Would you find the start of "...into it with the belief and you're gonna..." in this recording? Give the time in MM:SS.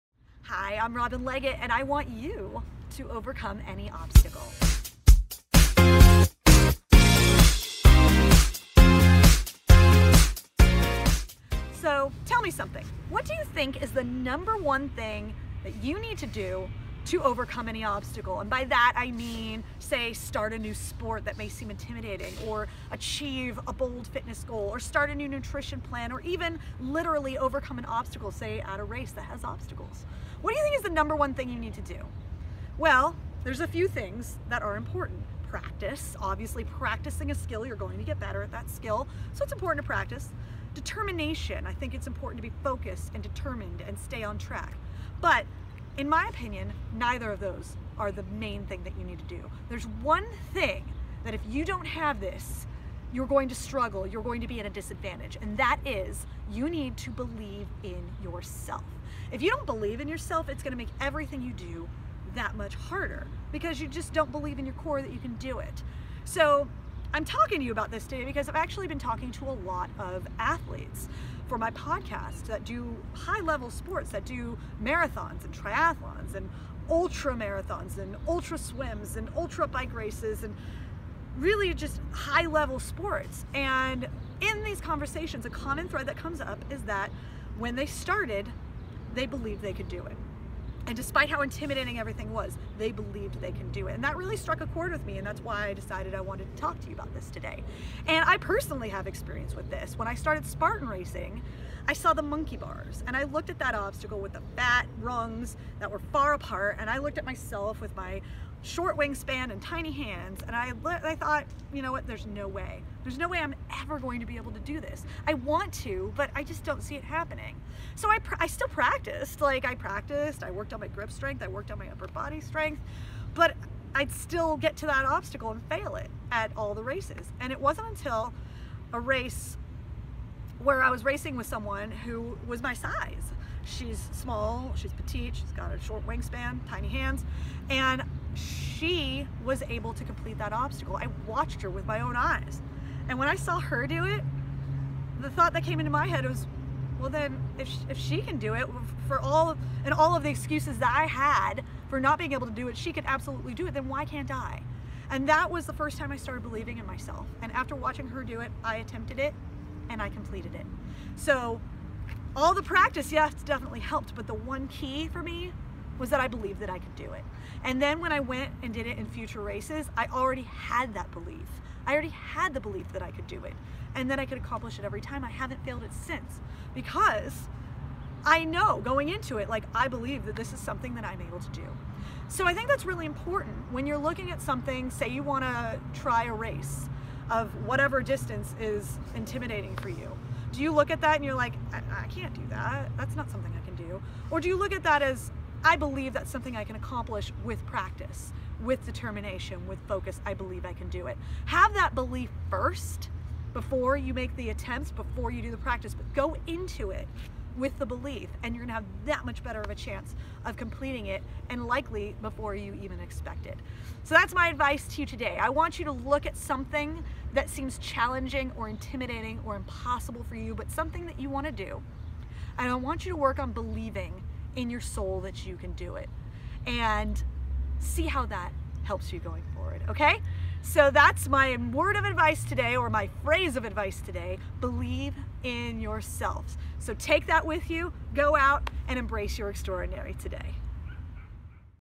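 03:26.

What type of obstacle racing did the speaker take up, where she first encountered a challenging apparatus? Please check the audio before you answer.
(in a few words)
Spartan racing.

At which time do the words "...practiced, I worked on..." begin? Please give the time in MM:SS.
01:59.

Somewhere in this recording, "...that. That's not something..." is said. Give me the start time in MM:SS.
03:12.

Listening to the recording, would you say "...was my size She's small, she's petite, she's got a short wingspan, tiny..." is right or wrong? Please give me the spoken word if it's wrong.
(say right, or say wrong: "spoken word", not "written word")
right.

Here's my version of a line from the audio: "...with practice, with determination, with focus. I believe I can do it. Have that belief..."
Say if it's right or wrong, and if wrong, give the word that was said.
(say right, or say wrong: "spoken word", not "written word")
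right.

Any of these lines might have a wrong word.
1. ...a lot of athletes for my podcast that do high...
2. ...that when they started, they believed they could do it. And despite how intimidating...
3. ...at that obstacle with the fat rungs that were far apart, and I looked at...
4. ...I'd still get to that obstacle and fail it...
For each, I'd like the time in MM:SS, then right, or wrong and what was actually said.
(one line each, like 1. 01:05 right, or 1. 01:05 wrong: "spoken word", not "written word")
1. 01:09 right
2. 01:26 right
3. 01:43 right
4. 02:03 right.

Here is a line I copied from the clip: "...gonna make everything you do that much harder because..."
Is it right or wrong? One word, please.
right.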